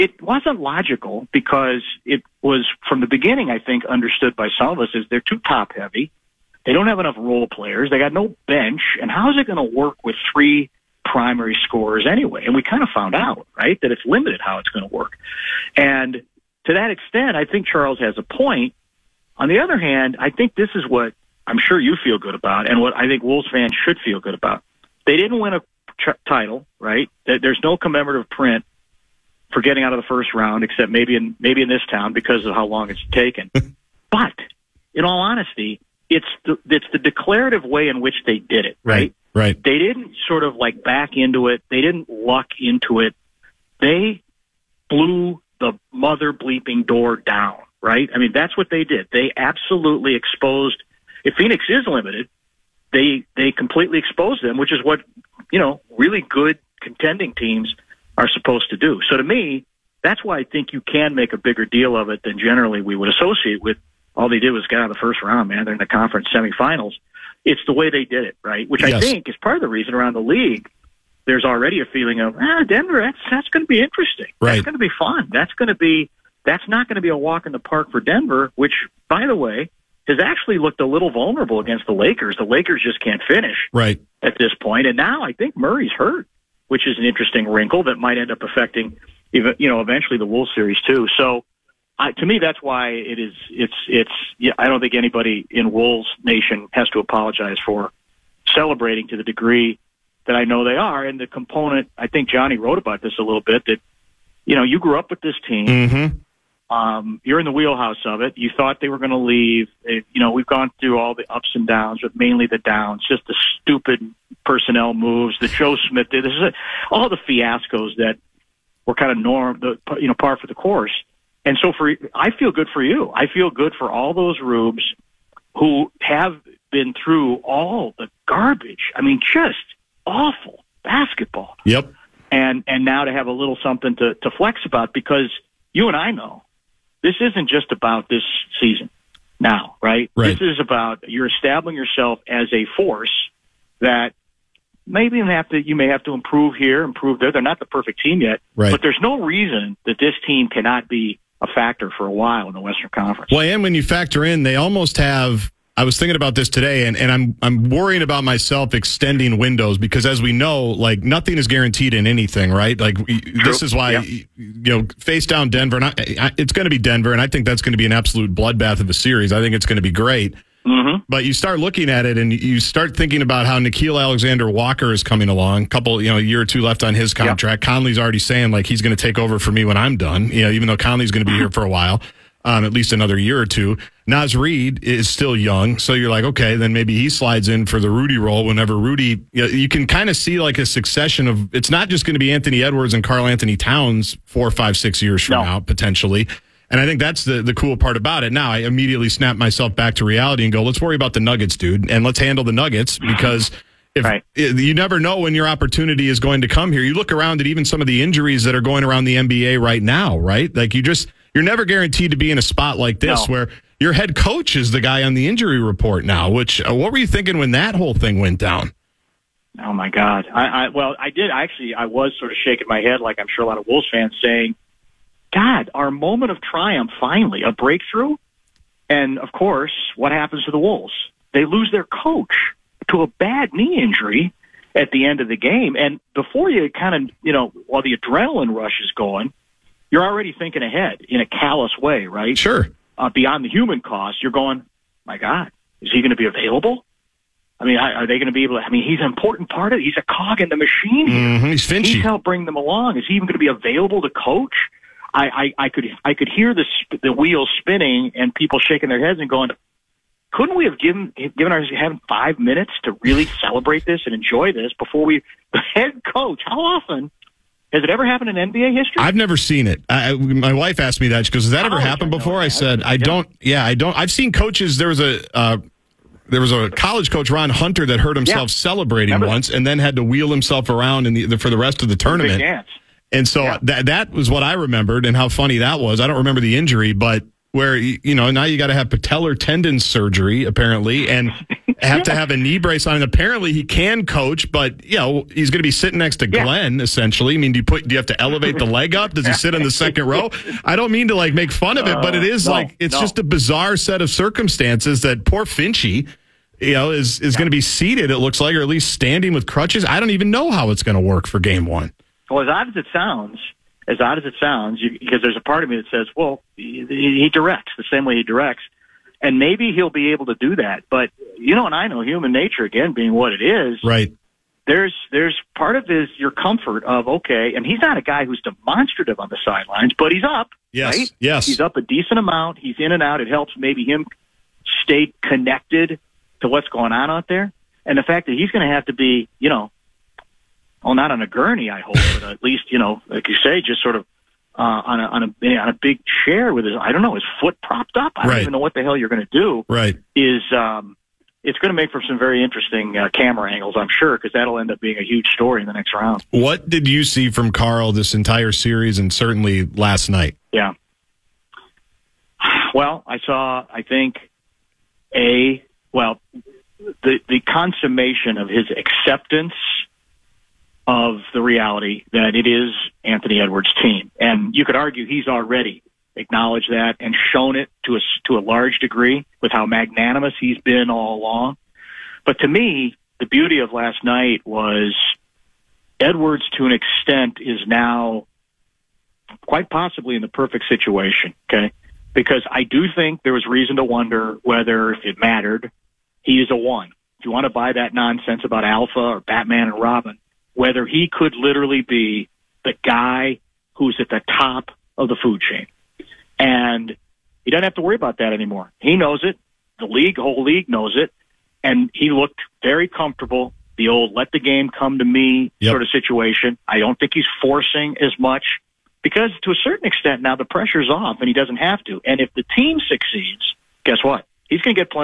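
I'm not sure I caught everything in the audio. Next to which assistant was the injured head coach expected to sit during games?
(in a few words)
Glenn.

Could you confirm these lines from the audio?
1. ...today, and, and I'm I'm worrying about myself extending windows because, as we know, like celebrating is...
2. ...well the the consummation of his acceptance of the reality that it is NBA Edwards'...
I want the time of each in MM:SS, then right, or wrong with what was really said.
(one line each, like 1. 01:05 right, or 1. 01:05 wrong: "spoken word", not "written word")
1. 02:36 wrong: "nothing", not "celebrating"
2. 06:05 wrong: "Anthony", not "NBA".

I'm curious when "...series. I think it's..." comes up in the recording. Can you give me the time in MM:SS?
02:48.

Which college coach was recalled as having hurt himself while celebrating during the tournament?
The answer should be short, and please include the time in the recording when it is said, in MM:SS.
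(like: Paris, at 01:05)
Ron Hunter, at 04:37.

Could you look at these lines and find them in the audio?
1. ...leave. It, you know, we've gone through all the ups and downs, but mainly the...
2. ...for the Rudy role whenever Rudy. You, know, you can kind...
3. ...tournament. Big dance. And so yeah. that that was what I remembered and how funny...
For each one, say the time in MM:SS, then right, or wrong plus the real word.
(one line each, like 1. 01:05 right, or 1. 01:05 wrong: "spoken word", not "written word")
1. 01:49 right
2. 03:07 right
3. 04:41 right.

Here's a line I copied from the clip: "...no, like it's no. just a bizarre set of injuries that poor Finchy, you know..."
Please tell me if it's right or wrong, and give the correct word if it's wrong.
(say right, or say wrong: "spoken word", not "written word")
wrong: "circumstances", not "injuries".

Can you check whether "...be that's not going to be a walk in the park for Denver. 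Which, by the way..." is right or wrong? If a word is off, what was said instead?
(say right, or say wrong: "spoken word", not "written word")
right.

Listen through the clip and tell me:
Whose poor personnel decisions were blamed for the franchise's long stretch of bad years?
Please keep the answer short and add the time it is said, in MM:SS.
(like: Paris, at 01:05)
Joe Smith, at 01:55.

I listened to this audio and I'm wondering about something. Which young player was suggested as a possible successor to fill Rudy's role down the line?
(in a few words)
Naz Reid.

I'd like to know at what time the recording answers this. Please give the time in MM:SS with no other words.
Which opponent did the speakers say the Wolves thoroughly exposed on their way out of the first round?
00:51.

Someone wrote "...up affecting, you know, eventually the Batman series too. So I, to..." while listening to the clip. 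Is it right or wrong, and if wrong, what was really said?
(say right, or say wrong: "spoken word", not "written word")
wrong: "Wolves", not "Batman".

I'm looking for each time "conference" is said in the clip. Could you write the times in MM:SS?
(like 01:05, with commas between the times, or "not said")
01:05, 02:32.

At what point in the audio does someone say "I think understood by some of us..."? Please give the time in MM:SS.
00:03.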